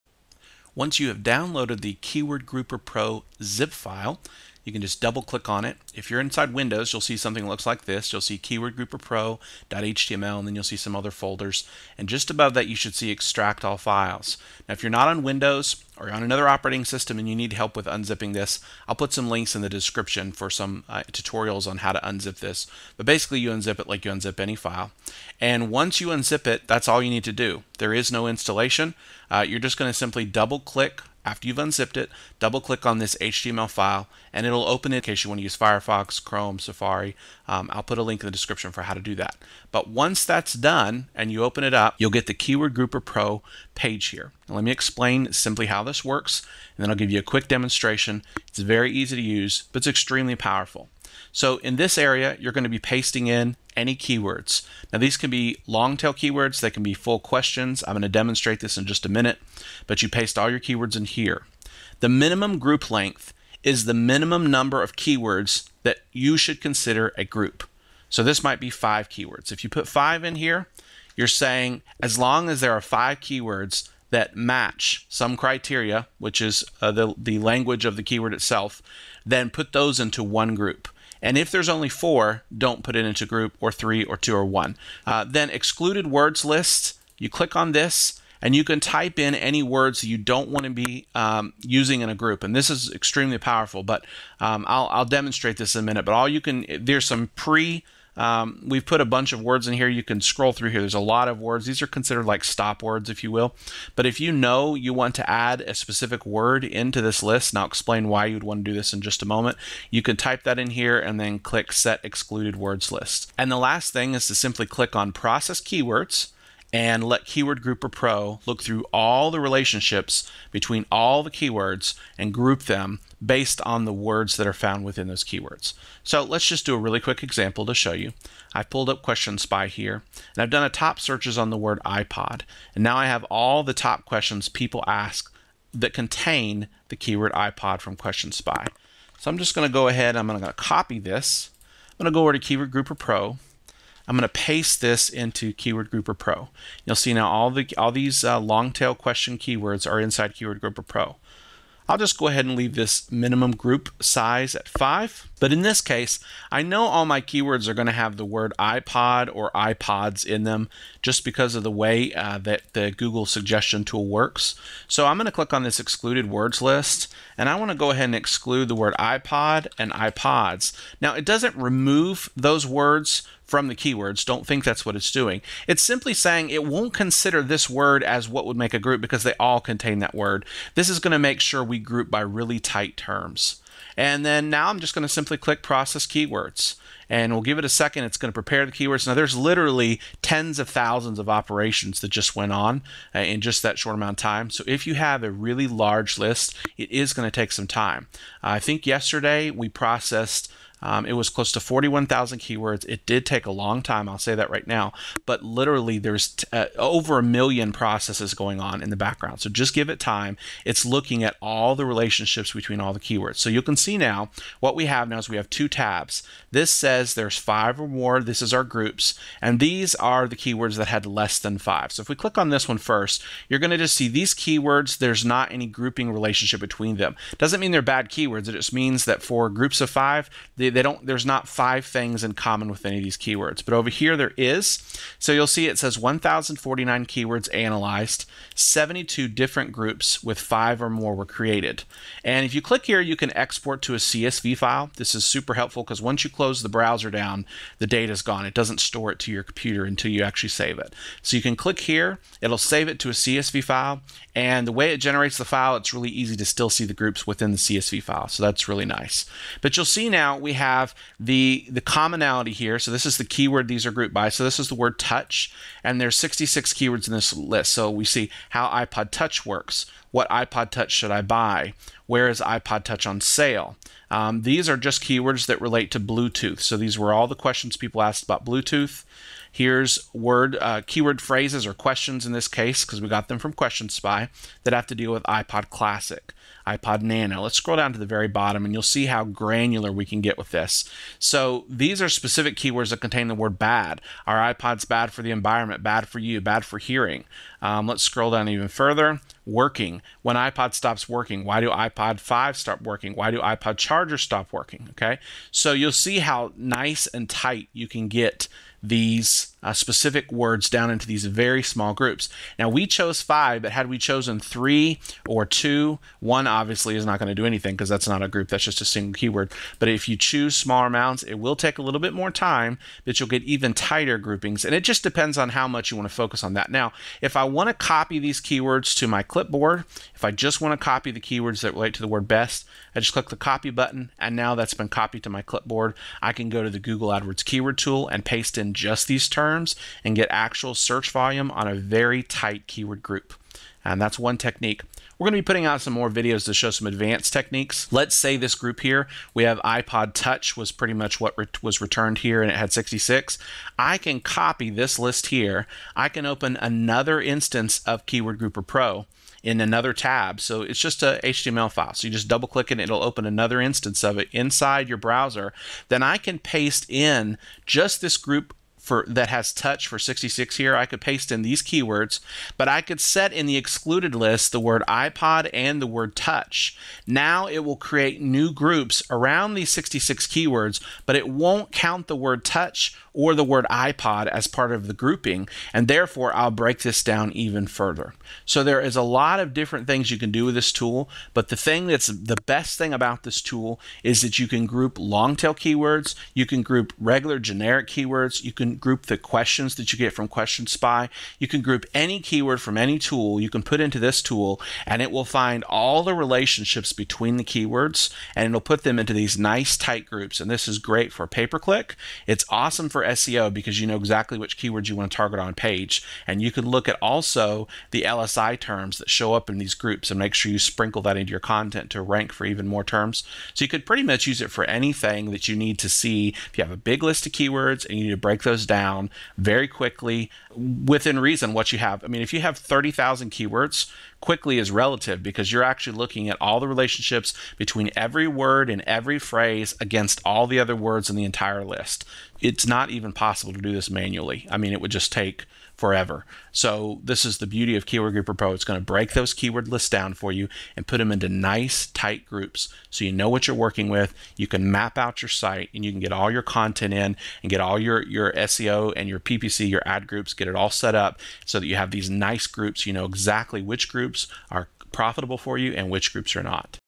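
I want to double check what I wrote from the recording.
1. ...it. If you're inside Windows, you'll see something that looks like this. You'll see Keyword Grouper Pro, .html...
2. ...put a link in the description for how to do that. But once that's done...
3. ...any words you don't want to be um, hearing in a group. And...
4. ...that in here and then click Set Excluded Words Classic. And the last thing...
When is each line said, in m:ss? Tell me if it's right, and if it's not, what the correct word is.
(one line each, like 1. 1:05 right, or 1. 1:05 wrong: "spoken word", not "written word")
1. 0:05 right
2. 0:37 right
3. 1:29 wrong: "using", not "hearing"
4. 1:50 wrong: "List", not "Classic".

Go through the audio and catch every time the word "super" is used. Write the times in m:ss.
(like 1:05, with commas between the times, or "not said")
4:05.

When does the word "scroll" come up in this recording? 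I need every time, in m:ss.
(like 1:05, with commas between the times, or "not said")
1:40, 4:47, 4:58.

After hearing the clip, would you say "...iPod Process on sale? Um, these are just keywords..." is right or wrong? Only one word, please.
wrong.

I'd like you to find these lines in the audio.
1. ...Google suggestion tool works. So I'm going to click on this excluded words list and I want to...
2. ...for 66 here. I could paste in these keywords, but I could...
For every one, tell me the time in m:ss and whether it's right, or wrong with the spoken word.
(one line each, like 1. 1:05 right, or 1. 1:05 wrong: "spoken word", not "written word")
1. 2:42 right
2. 6:09 right.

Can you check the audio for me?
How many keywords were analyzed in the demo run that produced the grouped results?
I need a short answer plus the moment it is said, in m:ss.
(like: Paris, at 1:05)
1049, at 3:55.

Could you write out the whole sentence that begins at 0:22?
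But basically, you unzip it like you unzip any file.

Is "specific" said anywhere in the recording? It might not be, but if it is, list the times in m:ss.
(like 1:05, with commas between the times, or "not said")
1:45, 4:52, 5:09.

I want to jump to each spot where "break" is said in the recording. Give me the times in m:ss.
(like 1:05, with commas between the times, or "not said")
6:26, 7:08, 7:28.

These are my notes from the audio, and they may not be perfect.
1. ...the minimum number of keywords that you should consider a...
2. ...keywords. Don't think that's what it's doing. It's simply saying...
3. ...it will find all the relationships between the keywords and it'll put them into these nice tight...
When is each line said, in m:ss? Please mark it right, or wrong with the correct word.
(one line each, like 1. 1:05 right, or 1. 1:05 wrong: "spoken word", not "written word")
1. 1:03 right
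2. 2:53 right
3. 6:45 right.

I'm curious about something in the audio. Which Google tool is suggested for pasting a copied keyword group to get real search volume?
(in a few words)
Google AdWords keyword tool.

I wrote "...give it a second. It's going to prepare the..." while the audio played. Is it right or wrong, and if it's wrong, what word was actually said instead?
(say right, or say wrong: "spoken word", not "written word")
right.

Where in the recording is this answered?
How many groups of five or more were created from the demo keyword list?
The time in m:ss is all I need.
3:58.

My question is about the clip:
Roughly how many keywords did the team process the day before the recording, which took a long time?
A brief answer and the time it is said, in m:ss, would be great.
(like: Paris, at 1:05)
41,000, at 3:21.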